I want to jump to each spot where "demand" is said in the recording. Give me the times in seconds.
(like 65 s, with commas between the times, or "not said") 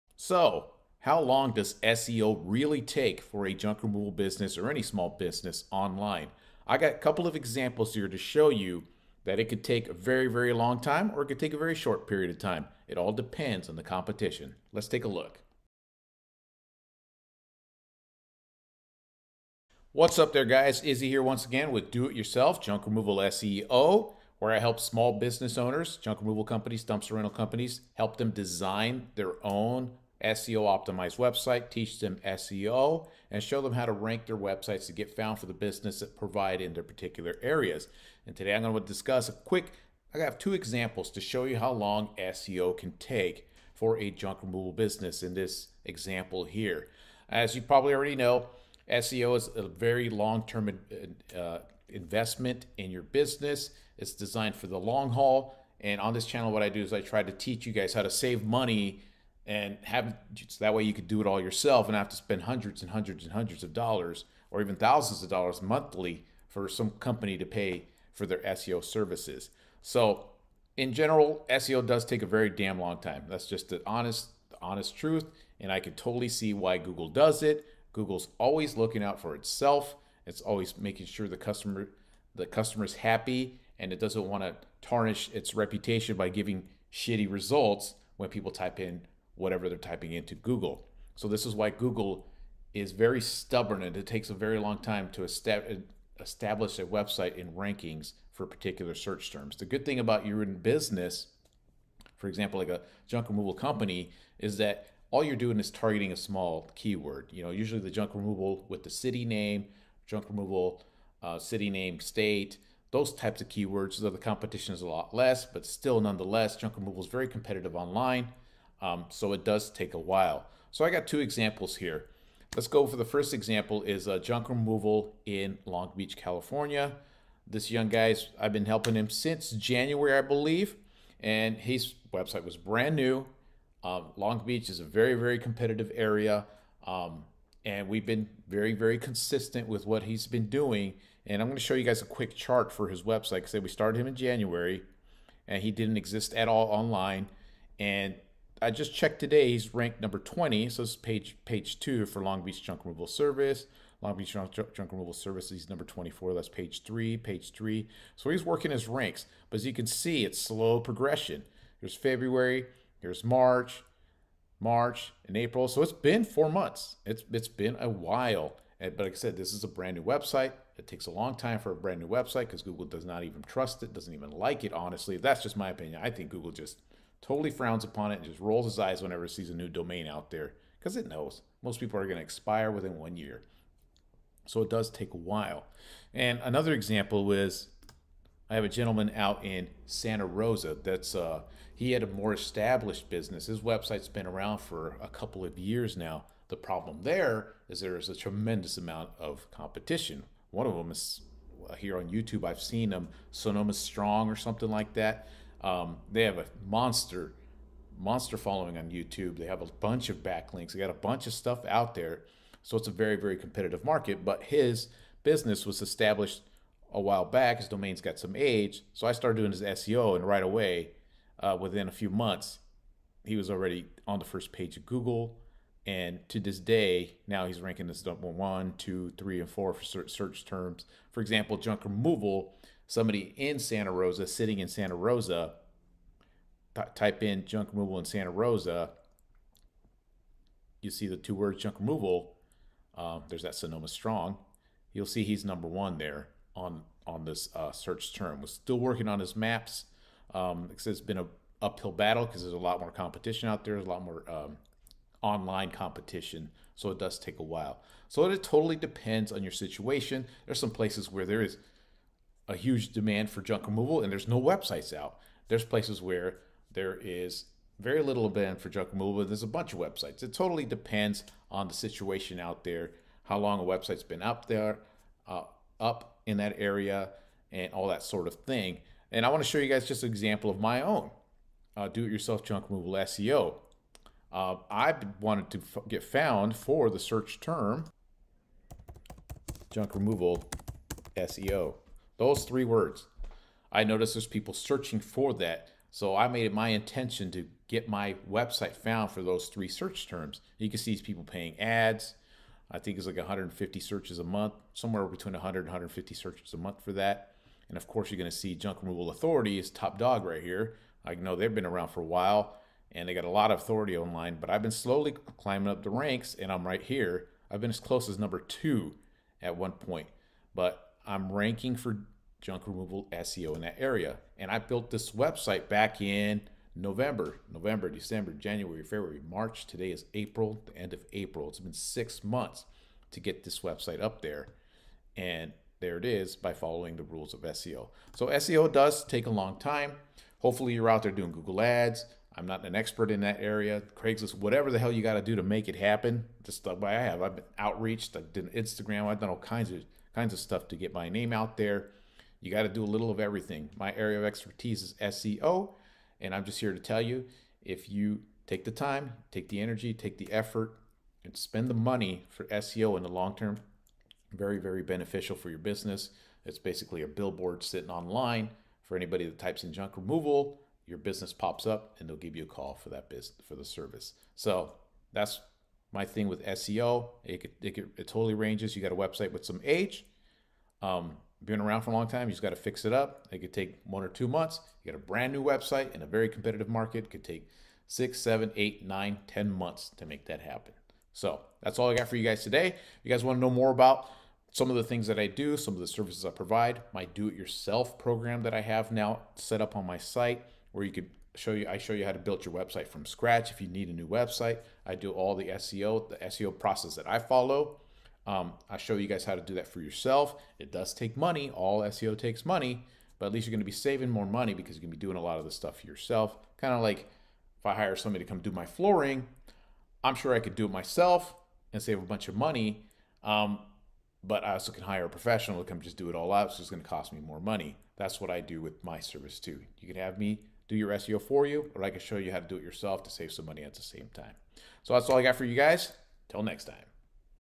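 262 s, 268 s.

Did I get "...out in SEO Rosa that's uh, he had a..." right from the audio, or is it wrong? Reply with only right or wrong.
wrong.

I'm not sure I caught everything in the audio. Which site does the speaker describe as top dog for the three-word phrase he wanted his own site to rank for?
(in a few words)
Junk Removal Authority.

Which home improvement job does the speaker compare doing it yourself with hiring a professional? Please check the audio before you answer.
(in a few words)
Flooring.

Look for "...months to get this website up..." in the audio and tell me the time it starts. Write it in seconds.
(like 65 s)
332 s.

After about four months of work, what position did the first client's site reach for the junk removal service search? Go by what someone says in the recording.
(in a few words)
20.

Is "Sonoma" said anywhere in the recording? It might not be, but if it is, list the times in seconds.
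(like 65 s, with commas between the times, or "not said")
203 s, 243 s.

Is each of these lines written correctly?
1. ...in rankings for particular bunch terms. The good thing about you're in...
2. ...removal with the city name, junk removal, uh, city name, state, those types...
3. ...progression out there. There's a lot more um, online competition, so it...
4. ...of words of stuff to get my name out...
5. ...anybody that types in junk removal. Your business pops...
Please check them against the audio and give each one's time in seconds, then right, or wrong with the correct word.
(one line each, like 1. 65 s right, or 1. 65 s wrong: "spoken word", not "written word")
1. 97 s wrong: "search", not "bunch"
2. 108 s right
3. 252 s wrong: "competition", not "progression"
4. 349 s wrong: "kinds", not "words"
5. 368 s right.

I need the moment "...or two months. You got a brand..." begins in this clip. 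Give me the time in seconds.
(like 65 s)
384 s.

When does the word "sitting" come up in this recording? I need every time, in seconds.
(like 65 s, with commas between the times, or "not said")
234 s, 367 s.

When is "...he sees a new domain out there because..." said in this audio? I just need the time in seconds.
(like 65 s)
179 s.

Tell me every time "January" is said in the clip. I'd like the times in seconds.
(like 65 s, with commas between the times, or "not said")
129 s, 144 s, 328 s.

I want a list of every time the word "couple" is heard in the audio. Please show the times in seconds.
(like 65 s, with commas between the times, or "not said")
6 s, 195 s.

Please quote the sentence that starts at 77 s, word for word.
Google's always looking out for itself.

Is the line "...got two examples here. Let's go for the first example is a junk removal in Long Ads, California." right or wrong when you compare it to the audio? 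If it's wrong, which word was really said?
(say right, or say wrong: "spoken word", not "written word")
wrong: "Beach", not "Ads".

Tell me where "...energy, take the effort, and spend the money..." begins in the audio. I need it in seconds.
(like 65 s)
359 s.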